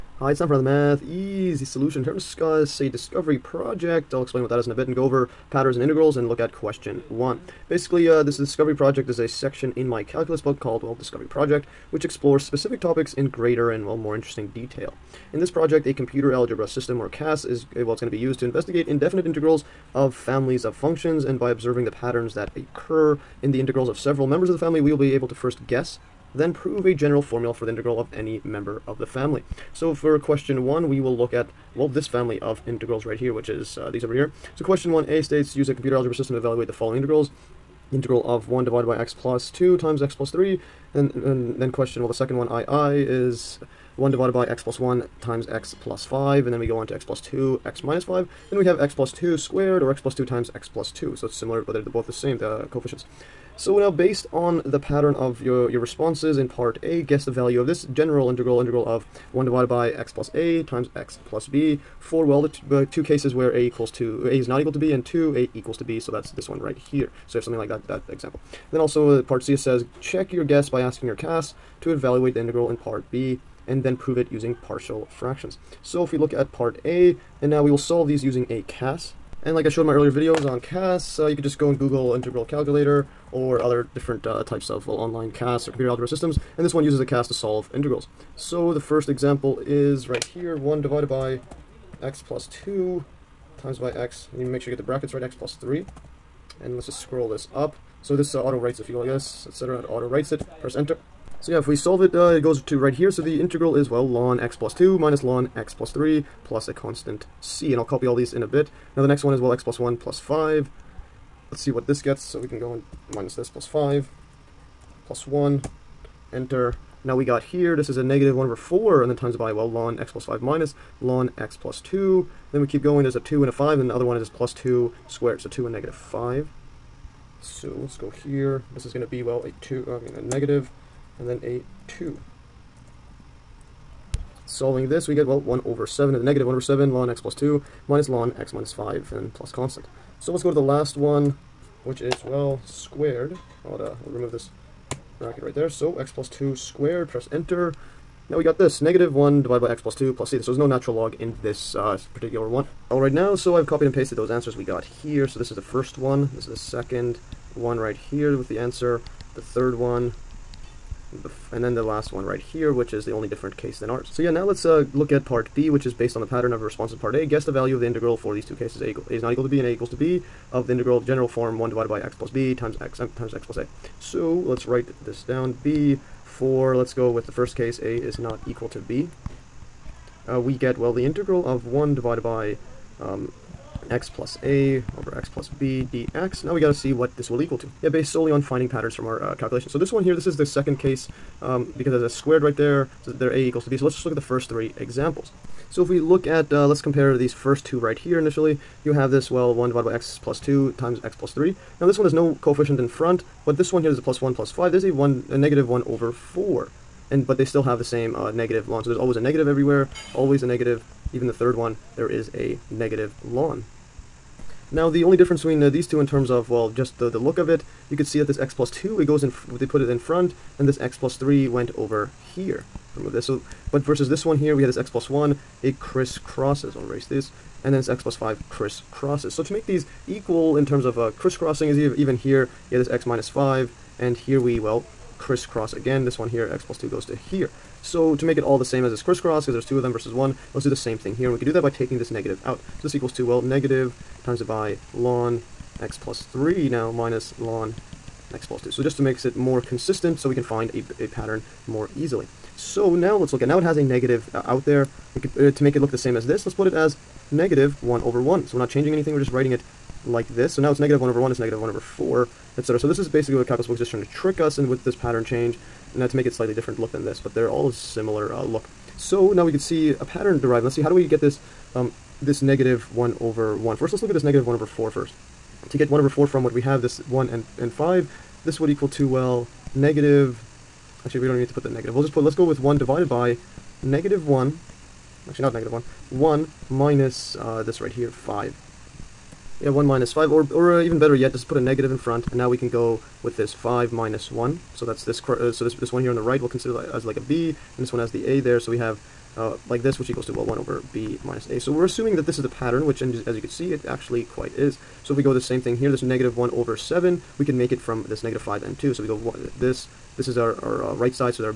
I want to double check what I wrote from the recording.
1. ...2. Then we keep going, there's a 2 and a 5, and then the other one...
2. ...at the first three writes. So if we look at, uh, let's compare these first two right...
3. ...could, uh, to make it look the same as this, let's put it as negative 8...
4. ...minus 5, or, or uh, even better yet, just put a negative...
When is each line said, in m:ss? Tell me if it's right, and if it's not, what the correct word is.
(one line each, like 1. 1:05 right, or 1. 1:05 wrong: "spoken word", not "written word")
1. 2:01 right
2. 3:14 wrong: "examples", not "writes"
3. 4:15 wrong: "1", not "8"
4. 4:49 right.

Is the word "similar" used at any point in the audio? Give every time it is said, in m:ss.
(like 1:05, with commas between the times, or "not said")
0:51, 4:27.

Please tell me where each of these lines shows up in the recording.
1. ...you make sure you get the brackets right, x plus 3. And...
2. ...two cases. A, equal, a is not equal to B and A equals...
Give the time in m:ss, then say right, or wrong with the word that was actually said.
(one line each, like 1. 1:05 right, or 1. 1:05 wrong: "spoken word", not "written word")
1. 1:34 right
2. 2:48 right.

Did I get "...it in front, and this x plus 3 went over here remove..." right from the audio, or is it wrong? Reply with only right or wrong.
right.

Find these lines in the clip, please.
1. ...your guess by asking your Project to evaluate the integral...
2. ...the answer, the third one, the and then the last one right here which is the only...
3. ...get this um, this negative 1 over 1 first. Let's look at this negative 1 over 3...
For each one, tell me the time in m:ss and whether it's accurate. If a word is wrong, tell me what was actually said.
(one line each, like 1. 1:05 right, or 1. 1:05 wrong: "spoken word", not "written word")
1. 1:10 wrong: "CAS", not "Project"
2. 2:38 right
3. 4:31 wrong: "4", not "3".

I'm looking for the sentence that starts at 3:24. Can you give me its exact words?
There's a, one, a negative 1 over 4.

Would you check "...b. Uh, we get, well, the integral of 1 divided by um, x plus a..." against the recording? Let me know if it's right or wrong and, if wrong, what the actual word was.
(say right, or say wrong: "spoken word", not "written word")
right.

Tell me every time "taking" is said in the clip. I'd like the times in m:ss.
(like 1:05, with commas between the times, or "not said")
4:01.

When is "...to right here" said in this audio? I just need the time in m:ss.
1:42.